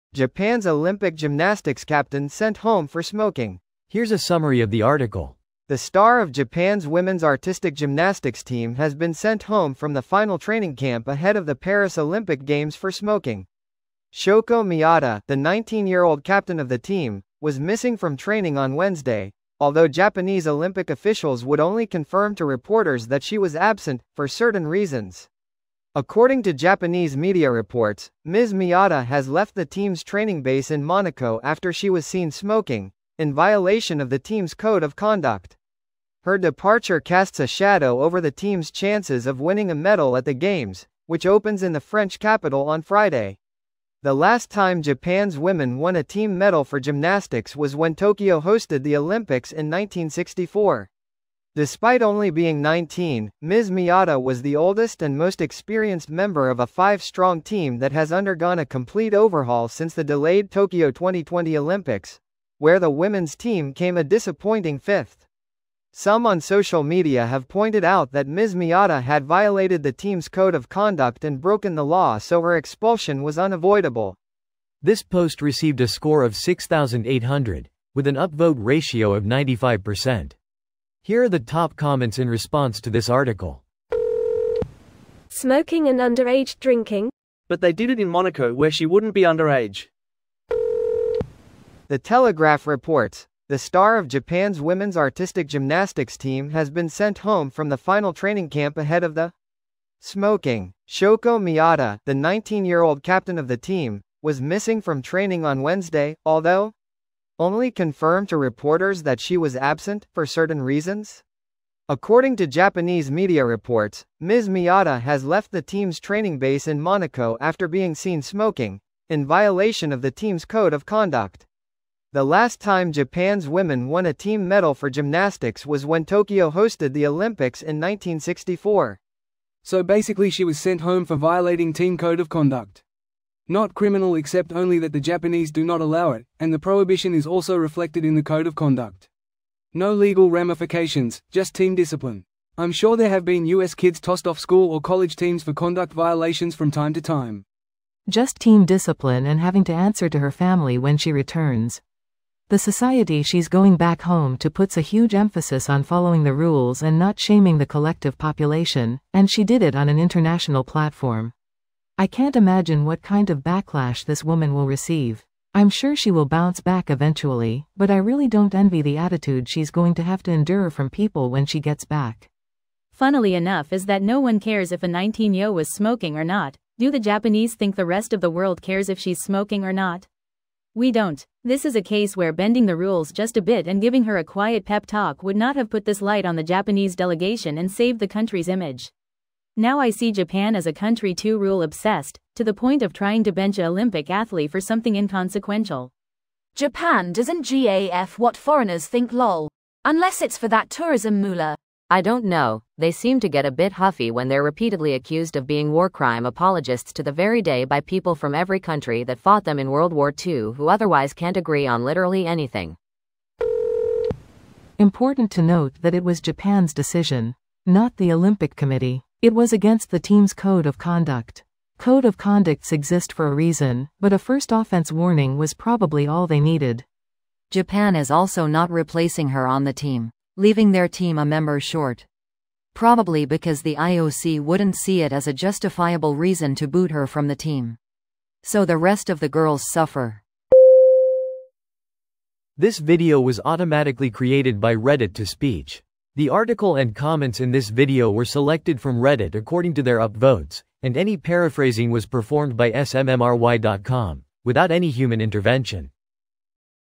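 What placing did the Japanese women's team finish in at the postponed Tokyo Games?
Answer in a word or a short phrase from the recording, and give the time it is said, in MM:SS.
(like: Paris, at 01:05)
fifth, at 01:04.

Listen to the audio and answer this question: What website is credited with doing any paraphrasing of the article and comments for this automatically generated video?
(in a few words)
SMMRY.com.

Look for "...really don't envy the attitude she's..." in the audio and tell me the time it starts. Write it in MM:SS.
02:47.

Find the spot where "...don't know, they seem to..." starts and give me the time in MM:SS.
03:22.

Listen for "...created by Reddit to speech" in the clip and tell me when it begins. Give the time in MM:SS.
04:04.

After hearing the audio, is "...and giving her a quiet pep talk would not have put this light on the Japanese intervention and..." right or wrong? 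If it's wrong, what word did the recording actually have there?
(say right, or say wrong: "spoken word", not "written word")
wrong: "delegation", not "intervention".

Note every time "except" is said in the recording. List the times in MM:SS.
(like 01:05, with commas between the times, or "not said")
02:14.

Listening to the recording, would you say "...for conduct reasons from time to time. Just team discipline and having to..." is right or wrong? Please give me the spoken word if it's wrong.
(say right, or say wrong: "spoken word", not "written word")
wrong: "violations", not "reasons".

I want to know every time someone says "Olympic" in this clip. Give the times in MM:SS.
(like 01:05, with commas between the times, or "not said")
00:00, 00:11, 00:20, 00:48, 01:01, 02:07, 03:13, 03:38.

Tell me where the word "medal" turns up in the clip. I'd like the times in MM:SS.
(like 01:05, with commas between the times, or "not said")
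00:39, 00:46, 02:04.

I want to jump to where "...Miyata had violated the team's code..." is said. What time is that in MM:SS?
01:08.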